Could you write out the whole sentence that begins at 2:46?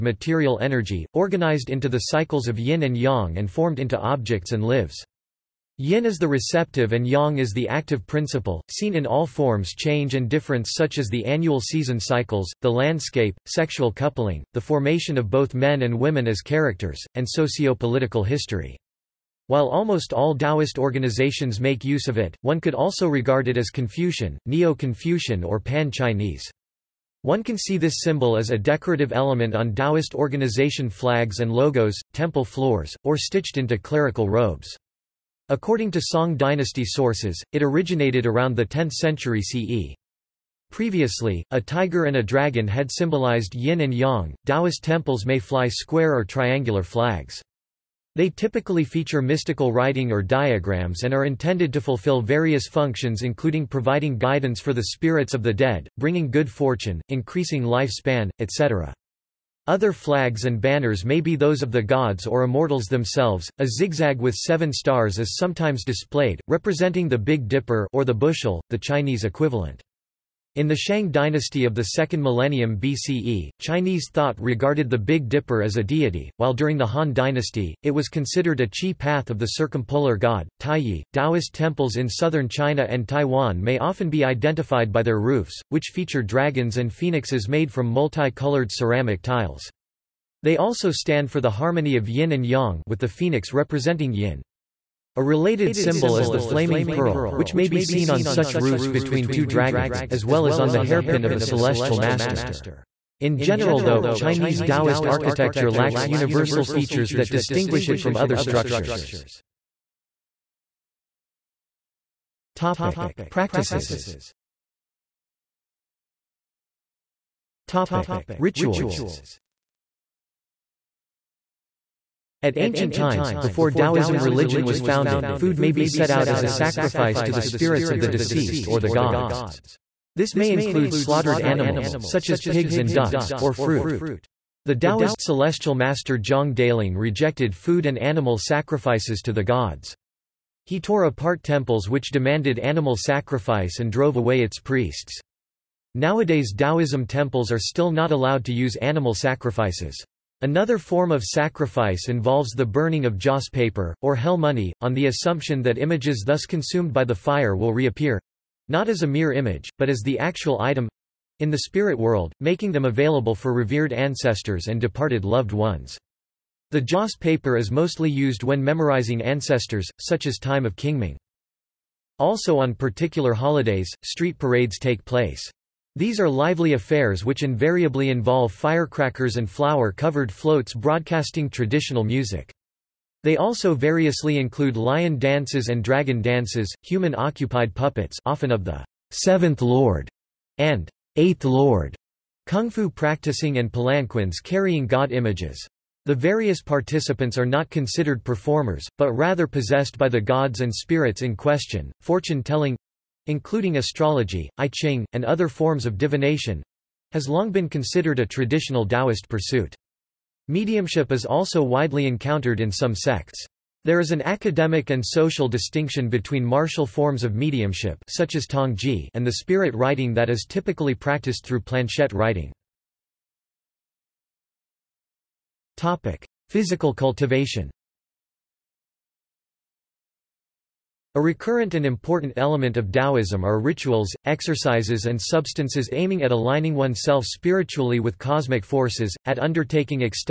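The joss paper is mostly used when memorizing ancestors, such as time of Qingming.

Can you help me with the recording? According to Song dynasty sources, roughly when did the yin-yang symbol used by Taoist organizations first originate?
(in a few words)
10th century CE.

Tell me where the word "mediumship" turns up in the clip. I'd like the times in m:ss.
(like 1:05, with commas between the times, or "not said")
3:30, 3:37.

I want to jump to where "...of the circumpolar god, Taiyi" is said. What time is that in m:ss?
1:19.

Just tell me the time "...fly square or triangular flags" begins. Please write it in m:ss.
0:45.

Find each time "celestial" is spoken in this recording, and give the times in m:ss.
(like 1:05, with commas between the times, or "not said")
1:41, 2:15.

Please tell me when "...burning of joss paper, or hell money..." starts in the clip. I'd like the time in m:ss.
2:32.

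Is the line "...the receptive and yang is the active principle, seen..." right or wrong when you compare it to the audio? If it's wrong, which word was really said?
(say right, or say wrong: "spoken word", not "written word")
right.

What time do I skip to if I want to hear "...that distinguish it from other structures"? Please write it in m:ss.
1:47.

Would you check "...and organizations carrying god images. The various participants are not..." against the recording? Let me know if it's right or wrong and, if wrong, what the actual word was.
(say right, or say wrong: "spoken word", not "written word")
wrong: "palanquins", not "organizations".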